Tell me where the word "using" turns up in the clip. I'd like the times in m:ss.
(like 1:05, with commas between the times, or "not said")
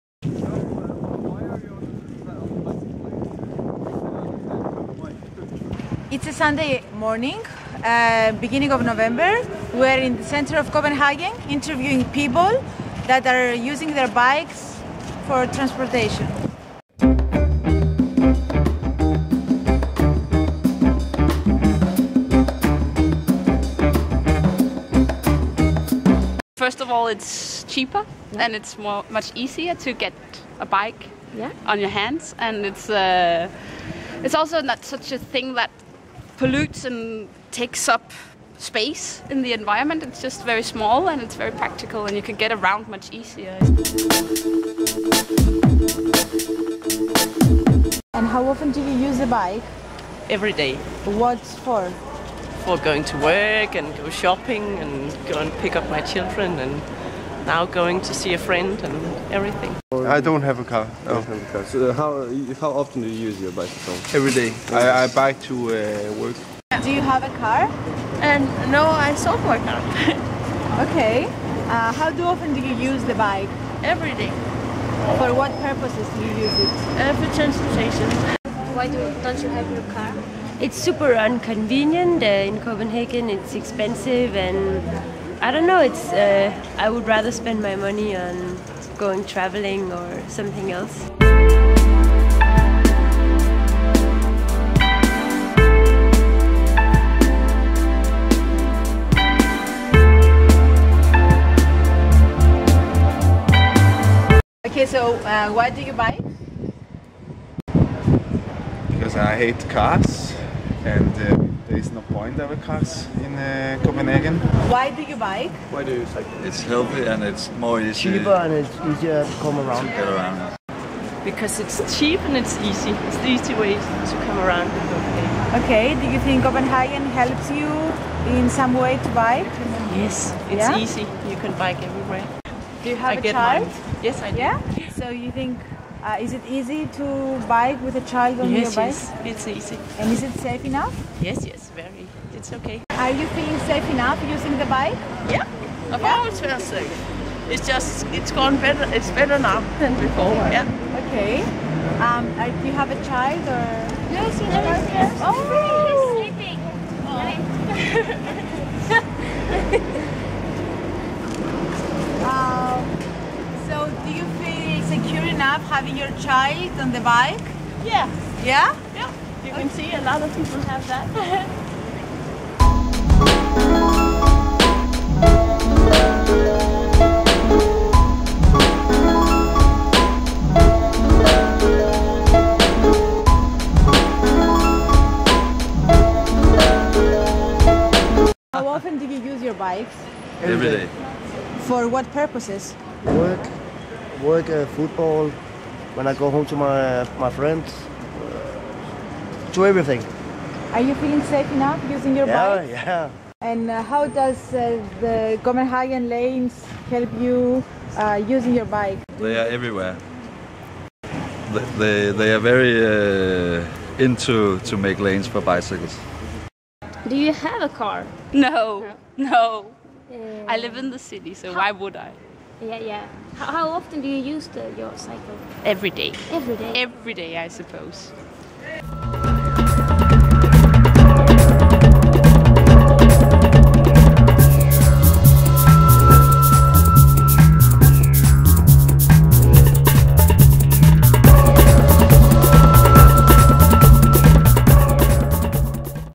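0:13, 2:24, 3:21, 3:28.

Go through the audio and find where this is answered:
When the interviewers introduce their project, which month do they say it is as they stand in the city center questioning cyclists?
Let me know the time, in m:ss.
0:08.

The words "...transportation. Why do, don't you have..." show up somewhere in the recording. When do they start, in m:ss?
1:17.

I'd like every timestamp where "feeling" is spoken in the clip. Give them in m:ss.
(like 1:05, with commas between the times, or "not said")
2:23, 3:20.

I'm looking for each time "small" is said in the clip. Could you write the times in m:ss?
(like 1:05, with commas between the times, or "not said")
0:40.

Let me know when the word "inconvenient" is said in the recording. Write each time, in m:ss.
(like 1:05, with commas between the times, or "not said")
1:21.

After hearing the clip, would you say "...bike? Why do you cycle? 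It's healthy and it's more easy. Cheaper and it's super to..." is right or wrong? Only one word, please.
wrong.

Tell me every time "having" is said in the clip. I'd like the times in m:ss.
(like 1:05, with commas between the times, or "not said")
2:45.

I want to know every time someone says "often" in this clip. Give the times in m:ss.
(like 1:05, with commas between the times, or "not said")
0:48, 1:02, 1:12, 3:08, 3:43.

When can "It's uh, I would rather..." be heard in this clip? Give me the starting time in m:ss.
1:25.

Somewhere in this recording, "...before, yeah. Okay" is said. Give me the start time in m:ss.
2:30.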